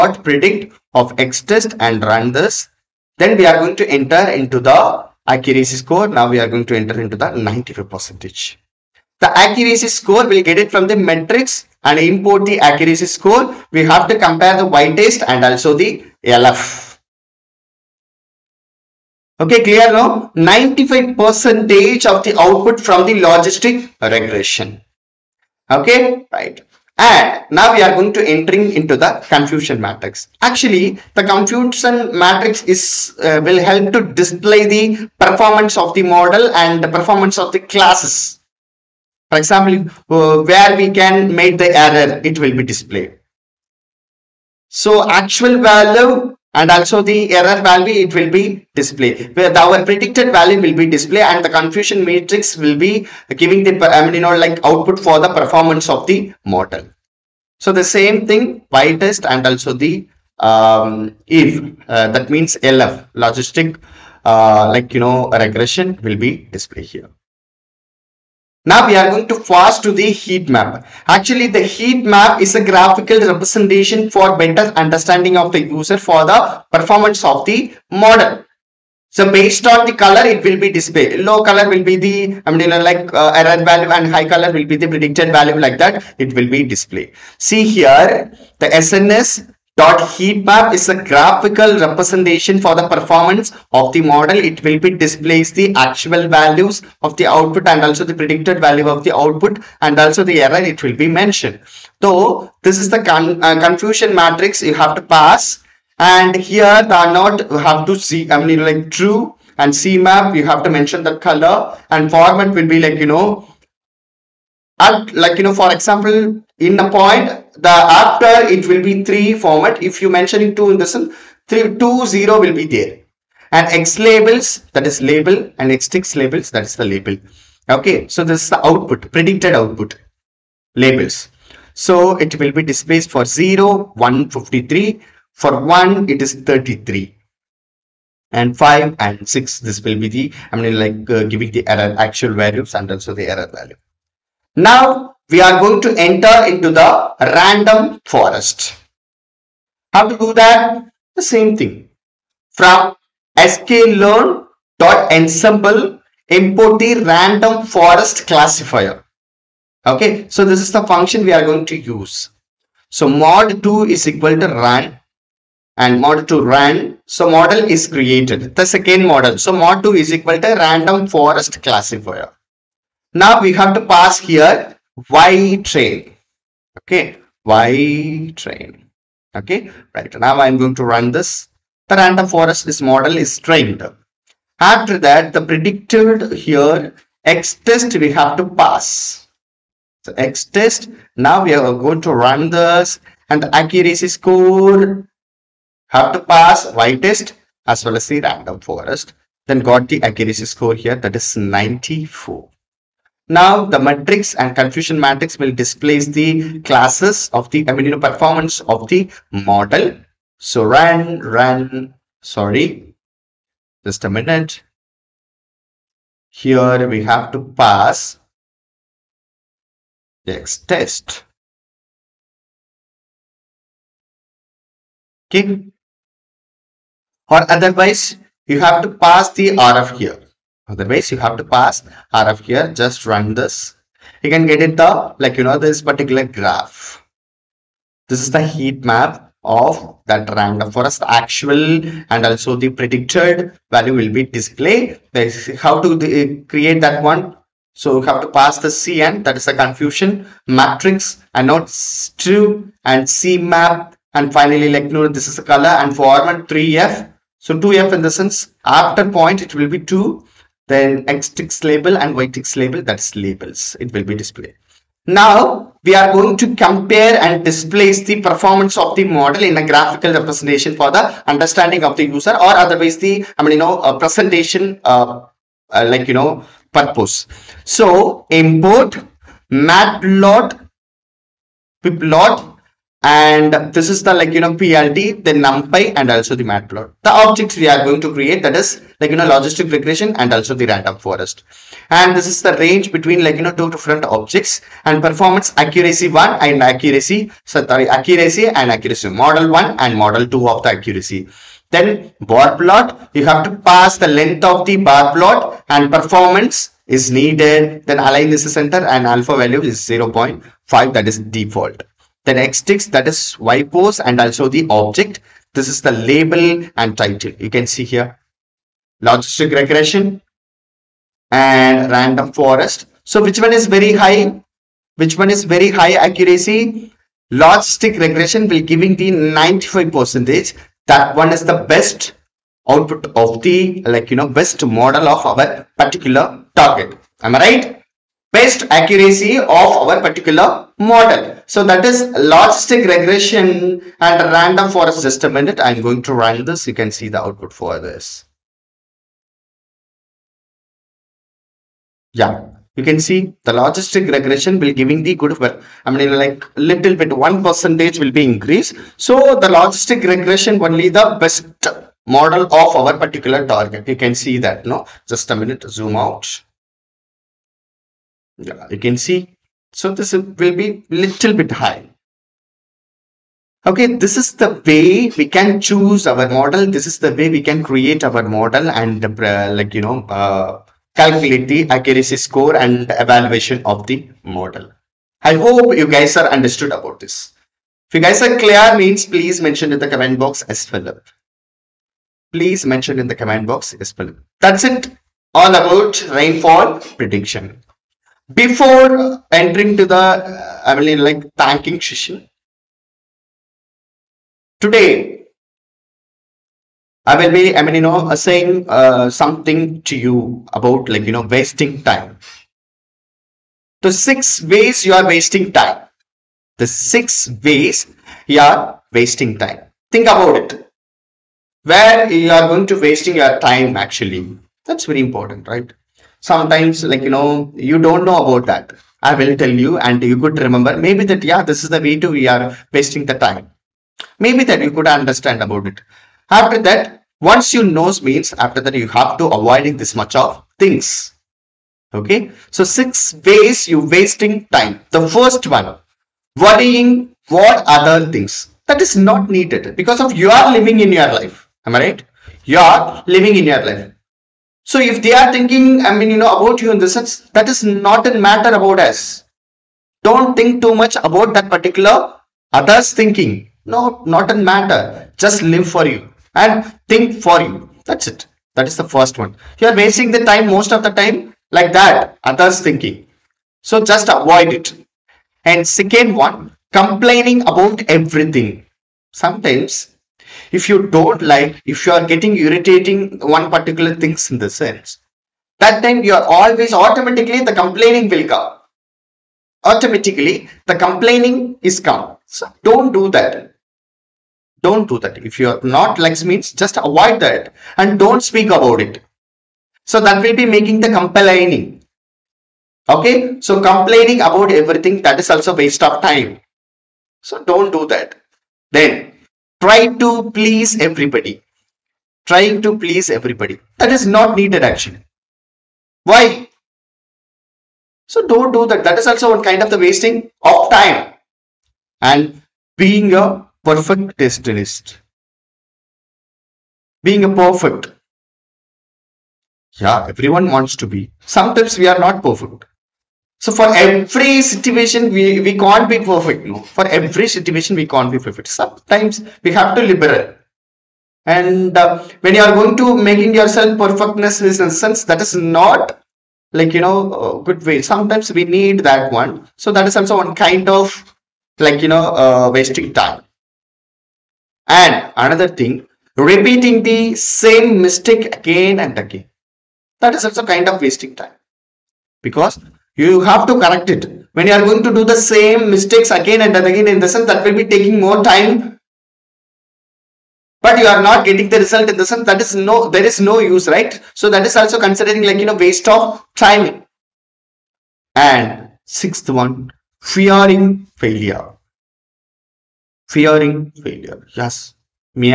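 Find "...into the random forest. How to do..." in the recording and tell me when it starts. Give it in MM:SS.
02:26.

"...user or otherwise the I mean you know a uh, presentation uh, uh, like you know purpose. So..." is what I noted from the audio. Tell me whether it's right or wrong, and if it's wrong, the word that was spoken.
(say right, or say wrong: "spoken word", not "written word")
right.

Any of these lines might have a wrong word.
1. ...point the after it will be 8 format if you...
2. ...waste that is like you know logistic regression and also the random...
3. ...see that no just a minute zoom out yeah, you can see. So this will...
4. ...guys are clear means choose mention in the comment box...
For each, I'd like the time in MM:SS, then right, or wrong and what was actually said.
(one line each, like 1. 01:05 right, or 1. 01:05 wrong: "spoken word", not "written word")
1. 01:56 wrong: "3", not "8"
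2. 04:48 wrong: "create", not "waste"
3. 06:04 right
4. 06:28 wrong: "please", not "choose".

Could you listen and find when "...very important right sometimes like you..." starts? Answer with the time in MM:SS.
07:04.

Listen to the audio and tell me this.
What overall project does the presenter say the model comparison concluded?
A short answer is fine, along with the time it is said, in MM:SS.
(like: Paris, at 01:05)
rainfall prediction, at 06:36.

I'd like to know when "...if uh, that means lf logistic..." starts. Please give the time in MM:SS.
01:01.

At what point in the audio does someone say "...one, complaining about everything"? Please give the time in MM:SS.
07:56.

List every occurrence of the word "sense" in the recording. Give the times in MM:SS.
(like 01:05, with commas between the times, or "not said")
04:18, 07:36, 08:04, 09:04, 09:27, 09:32.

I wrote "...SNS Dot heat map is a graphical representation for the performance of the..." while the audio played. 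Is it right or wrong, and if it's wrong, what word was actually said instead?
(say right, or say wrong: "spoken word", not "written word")
right.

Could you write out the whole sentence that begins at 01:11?
Actually the heat map is a graphical representation for better understanding of the user for the performance of the model.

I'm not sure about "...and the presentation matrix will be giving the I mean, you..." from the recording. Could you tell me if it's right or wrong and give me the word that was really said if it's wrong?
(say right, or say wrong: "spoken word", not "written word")
wrong: "confusion", not "presentation".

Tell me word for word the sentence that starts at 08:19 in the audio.
So that will be making the complaining.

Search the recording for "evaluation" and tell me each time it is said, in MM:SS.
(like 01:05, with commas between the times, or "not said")
06:22.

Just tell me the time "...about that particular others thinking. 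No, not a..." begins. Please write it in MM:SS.
07:40.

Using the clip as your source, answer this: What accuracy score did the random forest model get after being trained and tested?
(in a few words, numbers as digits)
94.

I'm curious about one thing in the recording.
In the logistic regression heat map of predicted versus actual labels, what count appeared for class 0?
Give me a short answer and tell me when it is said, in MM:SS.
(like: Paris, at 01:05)
153, at 02:14.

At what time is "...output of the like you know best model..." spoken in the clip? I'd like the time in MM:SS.
05:32.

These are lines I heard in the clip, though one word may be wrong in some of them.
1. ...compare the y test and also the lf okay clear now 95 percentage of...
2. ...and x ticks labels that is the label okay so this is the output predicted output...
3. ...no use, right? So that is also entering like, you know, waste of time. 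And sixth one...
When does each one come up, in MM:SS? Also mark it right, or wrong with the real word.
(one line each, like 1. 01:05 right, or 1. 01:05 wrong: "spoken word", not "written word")
1. 00:14 right
2. 02:05 right
3. 09:33 wrong: "considering", not "entering".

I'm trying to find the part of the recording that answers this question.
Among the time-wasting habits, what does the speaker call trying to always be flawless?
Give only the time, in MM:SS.
08:42.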